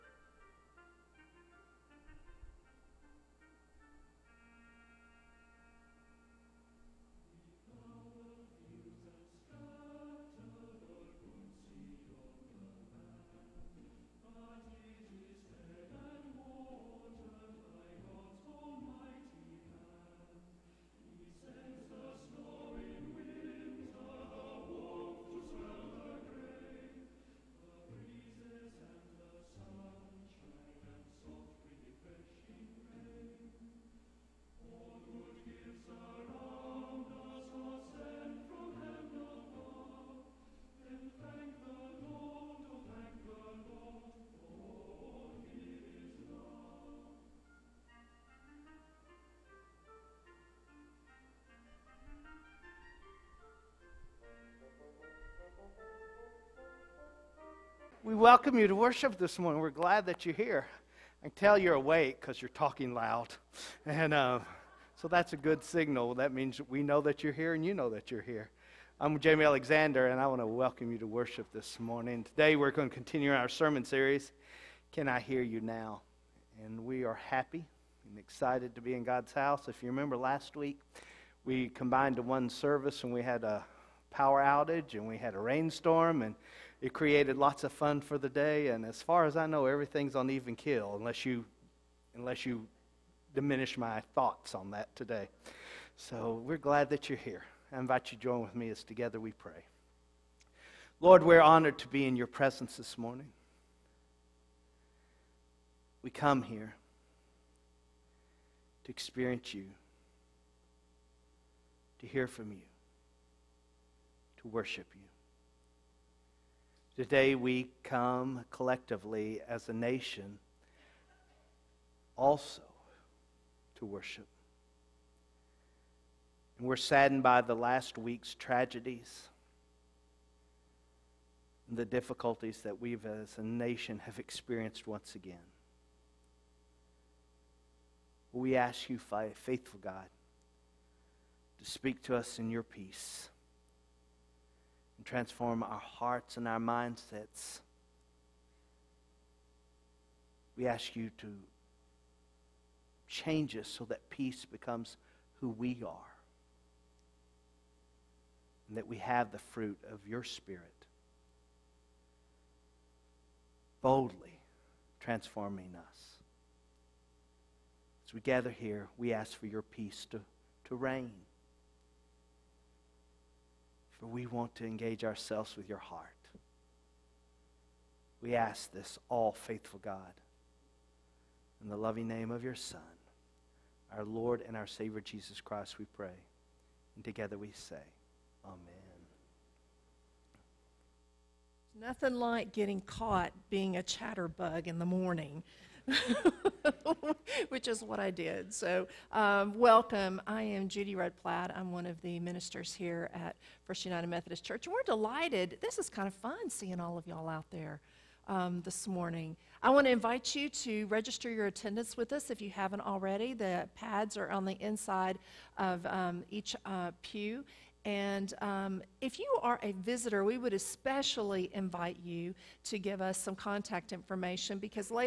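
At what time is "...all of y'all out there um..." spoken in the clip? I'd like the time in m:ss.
3:26.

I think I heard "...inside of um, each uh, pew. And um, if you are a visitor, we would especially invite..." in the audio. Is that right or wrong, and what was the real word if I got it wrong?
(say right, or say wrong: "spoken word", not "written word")
right.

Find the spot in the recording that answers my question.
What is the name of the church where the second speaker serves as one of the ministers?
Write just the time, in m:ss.
3:23.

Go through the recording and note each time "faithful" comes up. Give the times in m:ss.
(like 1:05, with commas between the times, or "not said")
2:18, 2:59.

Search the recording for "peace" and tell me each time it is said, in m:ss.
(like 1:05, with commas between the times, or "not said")
2:22, 2:34, 2:49.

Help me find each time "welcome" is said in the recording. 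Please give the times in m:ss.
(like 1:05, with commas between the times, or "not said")
0:58, 1:10, 3:19.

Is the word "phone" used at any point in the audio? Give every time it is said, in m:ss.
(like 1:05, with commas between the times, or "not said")
not said.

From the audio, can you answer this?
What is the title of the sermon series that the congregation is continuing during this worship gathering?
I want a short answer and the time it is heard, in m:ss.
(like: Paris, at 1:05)
Can I Hear You Now?, at 1:14.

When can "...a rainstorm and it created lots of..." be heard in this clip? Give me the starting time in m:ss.
1:25.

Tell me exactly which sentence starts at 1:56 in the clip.
Today we come collectively as a nation also to worship.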